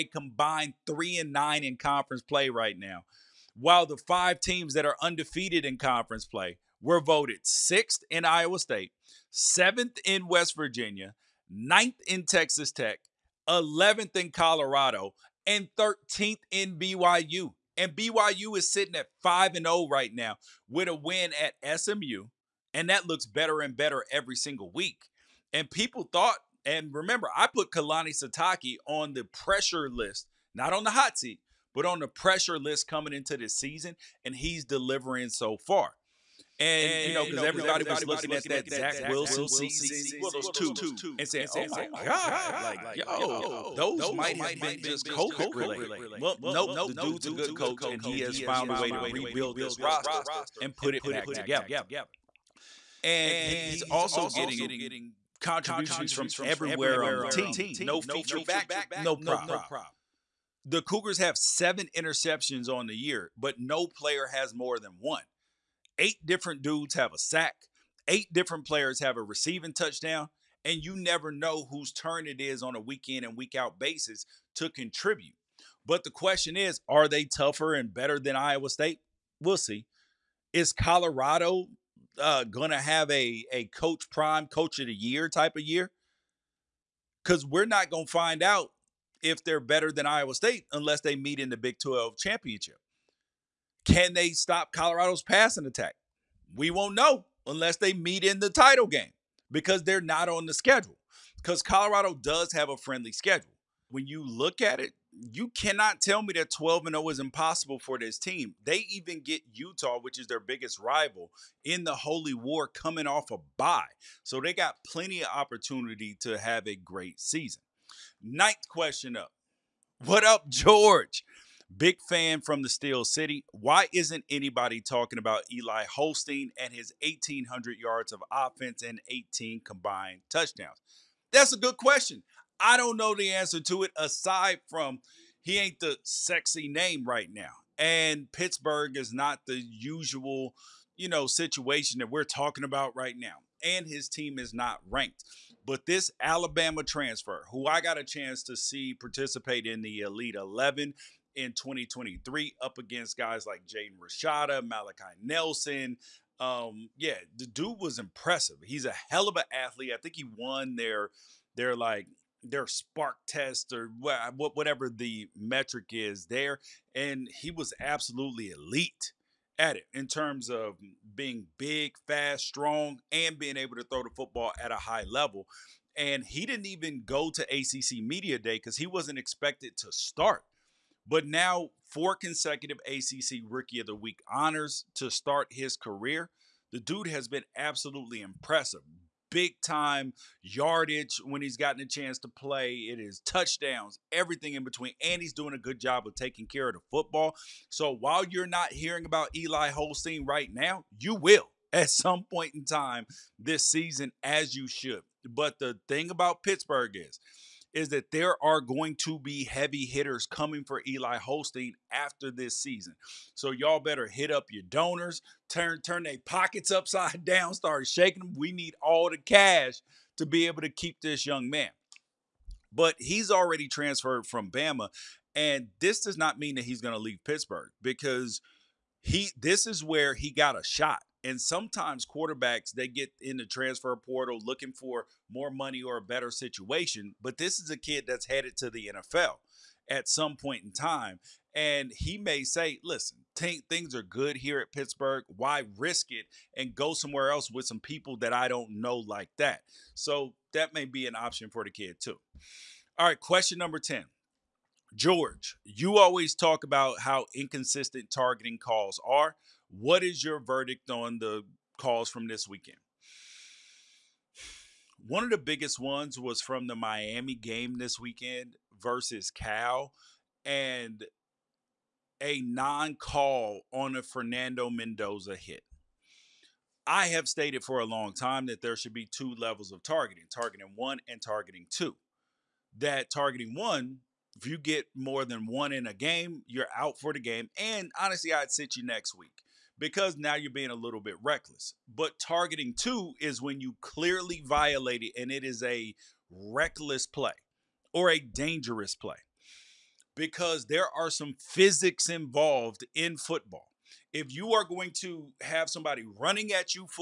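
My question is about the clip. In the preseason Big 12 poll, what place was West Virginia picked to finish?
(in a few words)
7th.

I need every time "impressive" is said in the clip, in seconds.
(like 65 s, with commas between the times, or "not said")
157 s, 188 s.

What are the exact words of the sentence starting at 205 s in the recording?
But the thing about Pittsburgh is, is that there are going to be heavy hitters coming for Eli Holstein after this season.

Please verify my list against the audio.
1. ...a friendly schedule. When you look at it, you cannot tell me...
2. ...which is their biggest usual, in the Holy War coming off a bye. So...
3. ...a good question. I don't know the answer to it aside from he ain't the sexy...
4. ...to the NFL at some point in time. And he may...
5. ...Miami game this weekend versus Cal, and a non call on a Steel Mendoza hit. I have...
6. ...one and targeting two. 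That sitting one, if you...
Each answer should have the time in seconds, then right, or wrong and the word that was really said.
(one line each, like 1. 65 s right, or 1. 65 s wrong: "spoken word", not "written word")
1. 102 s right
2. 109 s wrong: "rival", not "usual"
3. 131 s right
4. 238 s right
5. 266 s wrong: "Fernando", not "Steel"
6. 280 s wrong: "targeting", not "sitting".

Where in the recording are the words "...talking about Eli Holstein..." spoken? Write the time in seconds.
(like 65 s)
124 s.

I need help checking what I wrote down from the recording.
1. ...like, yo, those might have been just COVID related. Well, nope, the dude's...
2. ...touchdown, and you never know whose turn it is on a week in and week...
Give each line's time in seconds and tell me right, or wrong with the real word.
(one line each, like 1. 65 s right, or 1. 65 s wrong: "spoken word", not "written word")
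1. 42 s right
2. 69 s right.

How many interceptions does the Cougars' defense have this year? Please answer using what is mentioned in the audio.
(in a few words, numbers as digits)
7.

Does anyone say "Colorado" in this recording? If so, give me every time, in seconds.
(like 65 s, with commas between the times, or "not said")
14 s, 80 s, 94 s, 101 s.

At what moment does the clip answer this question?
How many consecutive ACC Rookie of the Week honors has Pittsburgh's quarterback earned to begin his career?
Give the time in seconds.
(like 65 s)
181 s.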